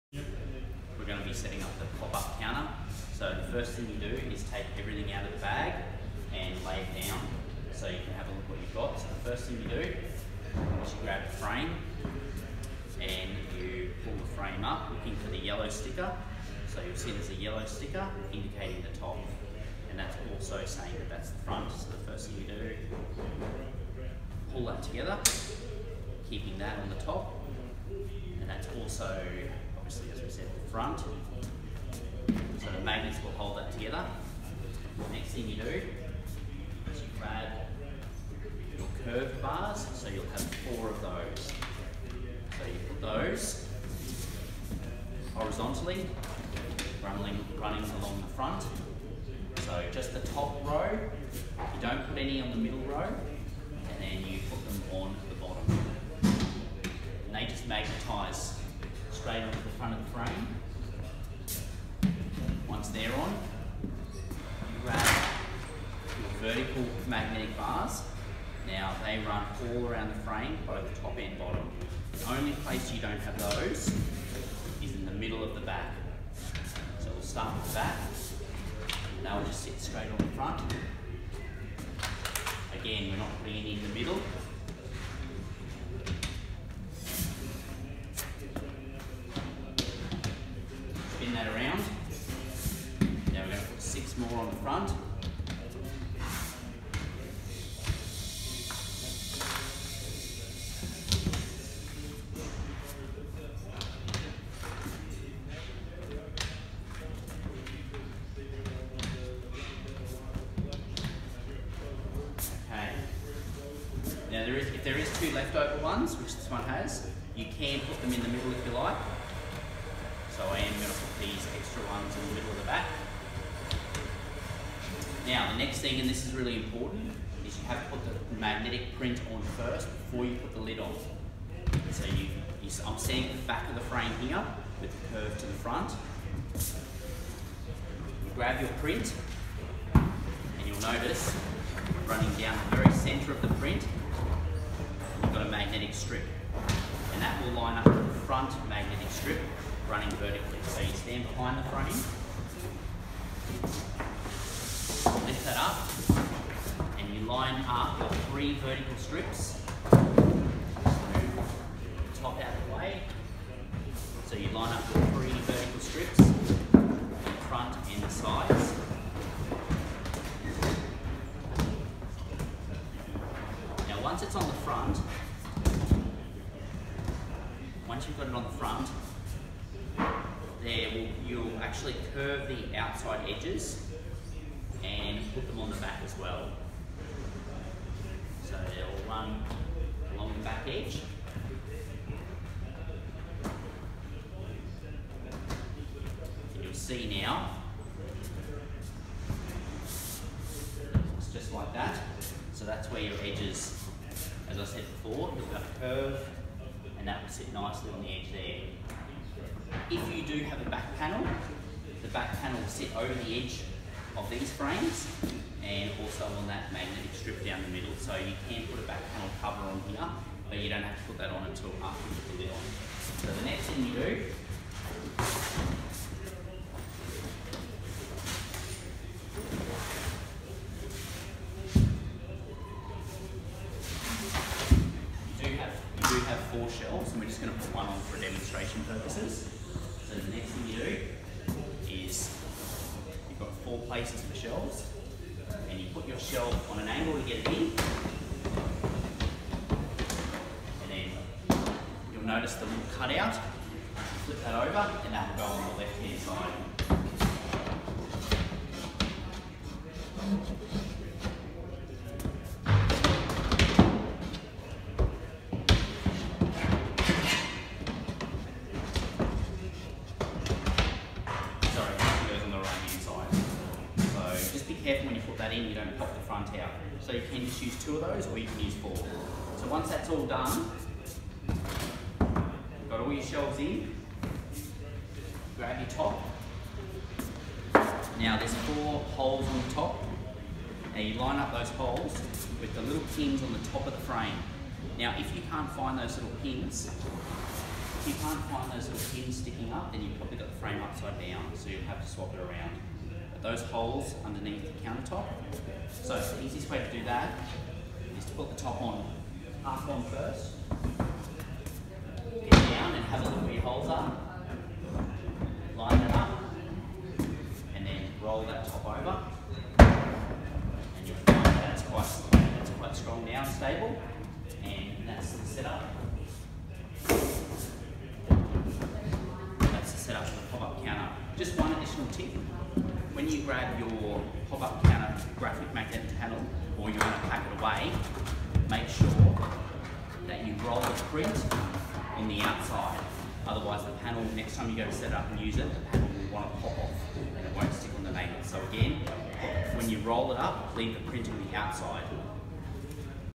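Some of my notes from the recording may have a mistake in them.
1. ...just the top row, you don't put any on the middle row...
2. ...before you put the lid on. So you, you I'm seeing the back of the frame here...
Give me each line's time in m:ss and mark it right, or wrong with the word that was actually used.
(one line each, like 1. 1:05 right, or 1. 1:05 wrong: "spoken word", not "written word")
1. 0:49 right
2. 2:10 right.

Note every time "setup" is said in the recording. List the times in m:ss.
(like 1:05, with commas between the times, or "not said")
5:25, 5:29.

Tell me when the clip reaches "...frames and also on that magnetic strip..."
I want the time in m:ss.
3:34.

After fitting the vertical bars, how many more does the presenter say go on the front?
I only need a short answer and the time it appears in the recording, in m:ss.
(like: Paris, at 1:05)
6, at 1:33.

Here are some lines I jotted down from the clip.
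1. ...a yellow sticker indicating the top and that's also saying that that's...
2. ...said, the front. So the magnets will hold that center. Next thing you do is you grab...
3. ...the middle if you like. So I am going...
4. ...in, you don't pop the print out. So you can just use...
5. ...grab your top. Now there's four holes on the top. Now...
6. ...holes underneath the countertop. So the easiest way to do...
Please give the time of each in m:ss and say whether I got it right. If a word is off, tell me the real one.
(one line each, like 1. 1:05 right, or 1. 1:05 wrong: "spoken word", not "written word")
1. 0:17 right
2. 0:30 wrong: "together", not "center"
3. 1:58 right
4. 4:35 wrong: "front", not "print"
5. 4:45 right
6. 5:03 right.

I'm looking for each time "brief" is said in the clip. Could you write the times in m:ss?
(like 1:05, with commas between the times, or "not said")
not said.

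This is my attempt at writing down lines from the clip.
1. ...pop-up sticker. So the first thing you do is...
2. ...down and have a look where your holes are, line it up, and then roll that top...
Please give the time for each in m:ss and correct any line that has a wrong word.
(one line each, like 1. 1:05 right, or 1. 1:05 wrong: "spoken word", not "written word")
1. 0:01 wrong: "counter", not "sticker"
2. 5:12 right.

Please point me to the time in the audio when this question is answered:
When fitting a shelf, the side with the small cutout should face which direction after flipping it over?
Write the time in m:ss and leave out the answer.
4:15.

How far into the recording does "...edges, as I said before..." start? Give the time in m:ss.
3:23.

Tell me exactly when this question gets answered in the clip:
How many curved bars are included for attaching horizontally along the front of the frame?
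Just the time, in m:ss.
0:40.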